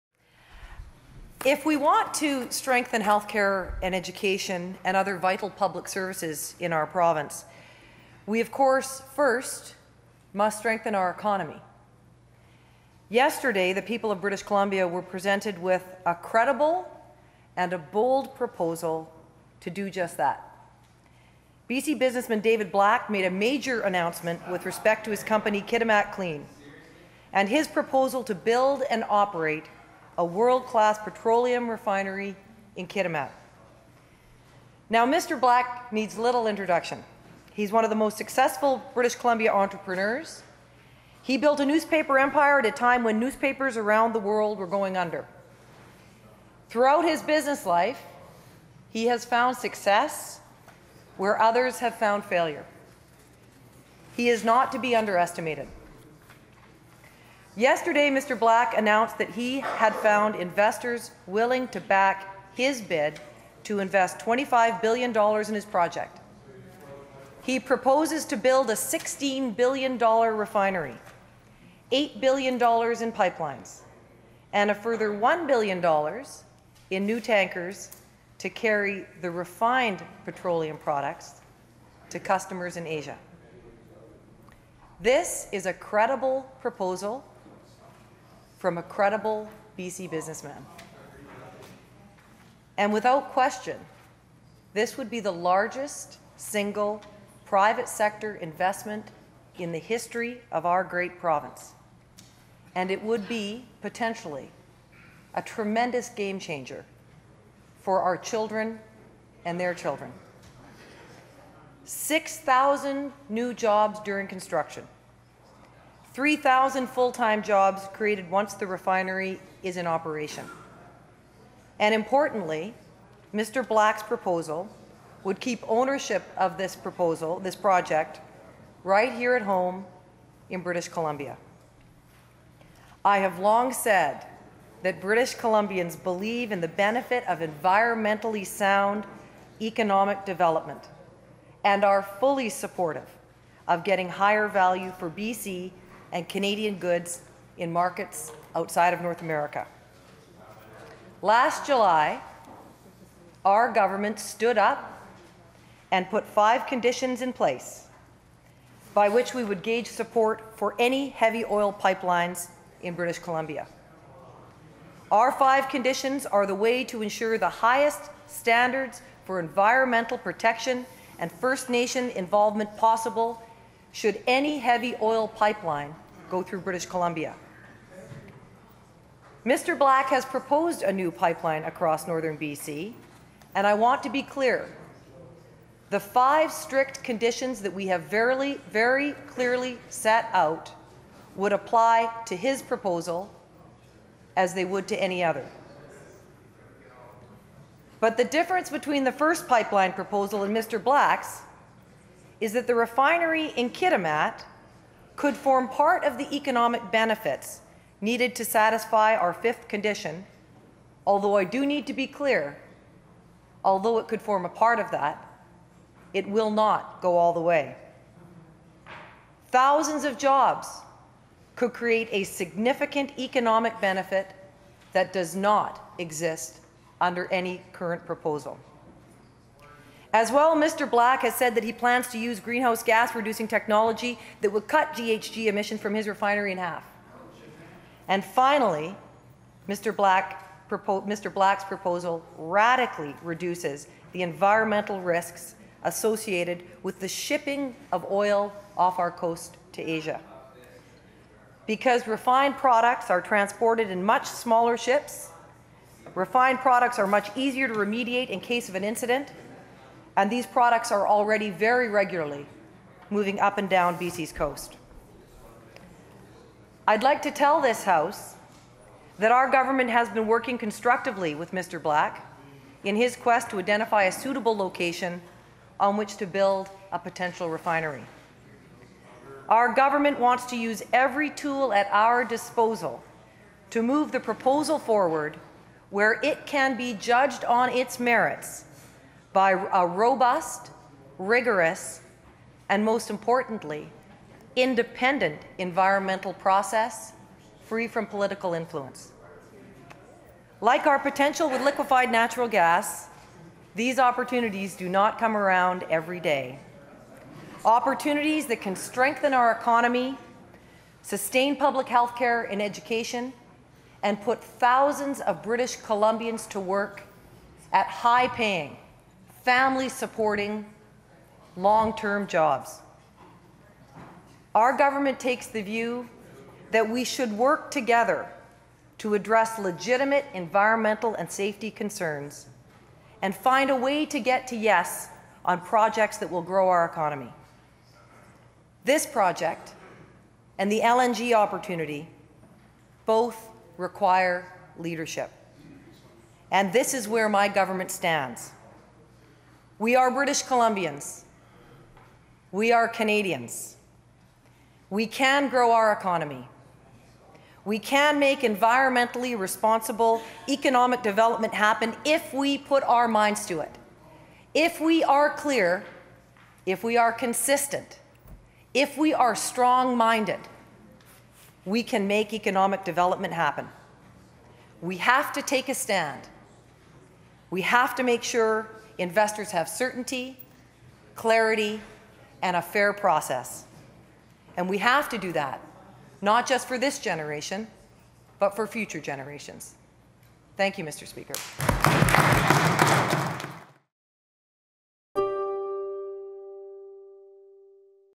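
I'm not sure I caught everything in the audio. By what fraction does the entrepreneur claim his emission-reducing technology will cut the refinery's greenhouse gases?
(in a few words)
in half.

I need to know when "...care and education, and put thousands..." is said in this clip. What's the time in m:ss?
5:12.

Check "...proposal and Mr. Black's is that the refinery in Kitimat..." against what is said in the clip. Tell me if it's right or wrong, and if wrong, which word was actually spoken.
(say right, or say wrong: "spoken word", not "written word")
right.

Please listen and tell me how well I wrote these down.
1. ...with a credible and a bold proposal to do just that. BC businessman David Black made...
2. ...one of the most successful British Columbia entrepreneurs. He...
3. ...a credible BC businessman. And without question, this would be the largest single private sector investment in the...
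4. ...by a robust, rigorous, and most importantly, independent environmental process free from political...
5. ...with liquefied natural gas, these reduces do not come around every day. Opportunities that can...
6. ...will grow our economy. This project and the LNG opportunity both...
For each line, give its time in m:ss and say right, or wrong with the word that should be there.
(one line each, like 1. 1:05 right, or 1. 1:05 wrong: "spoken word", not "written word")
1. 0:15 right
2. 0:37 right
3. 1:28 right
4. 4:49 right
5. 5:01 wrong: "opportunities", not "reduces"
6. 5:36 right.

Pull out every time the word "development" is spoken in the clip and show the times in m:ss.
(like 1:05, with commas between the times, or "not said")
2:20, 6:01, 6:12.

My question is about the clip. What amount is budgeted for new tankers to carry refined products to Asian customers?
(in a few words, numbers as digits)
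$1 billion.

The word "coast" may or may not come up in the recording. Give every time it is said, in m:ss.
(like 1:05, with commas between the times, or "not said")
4:09, 4:24.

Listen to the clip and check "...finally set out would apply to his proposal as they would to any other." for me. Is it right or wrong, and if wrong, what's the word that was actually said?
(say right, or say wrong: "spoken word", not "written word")
wrong: "clearly", not "finally".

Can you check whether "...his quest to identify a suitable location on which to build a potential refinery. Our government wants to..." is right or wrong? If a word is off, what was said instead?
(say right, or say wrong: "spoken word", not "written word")
right.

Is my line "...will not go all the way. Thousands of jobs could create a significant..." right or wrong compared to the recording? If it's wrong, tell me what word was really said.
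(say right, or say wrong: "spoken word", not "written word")
right.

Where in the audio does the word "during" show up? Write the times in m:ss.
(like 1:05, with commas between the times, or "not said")
1:54.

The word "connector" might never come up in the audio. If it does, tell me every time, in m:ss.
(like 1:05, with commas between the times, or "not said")
not said.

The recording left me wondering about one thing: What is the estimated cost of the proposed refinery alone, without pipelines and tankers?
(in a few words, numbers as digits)
$16 billion.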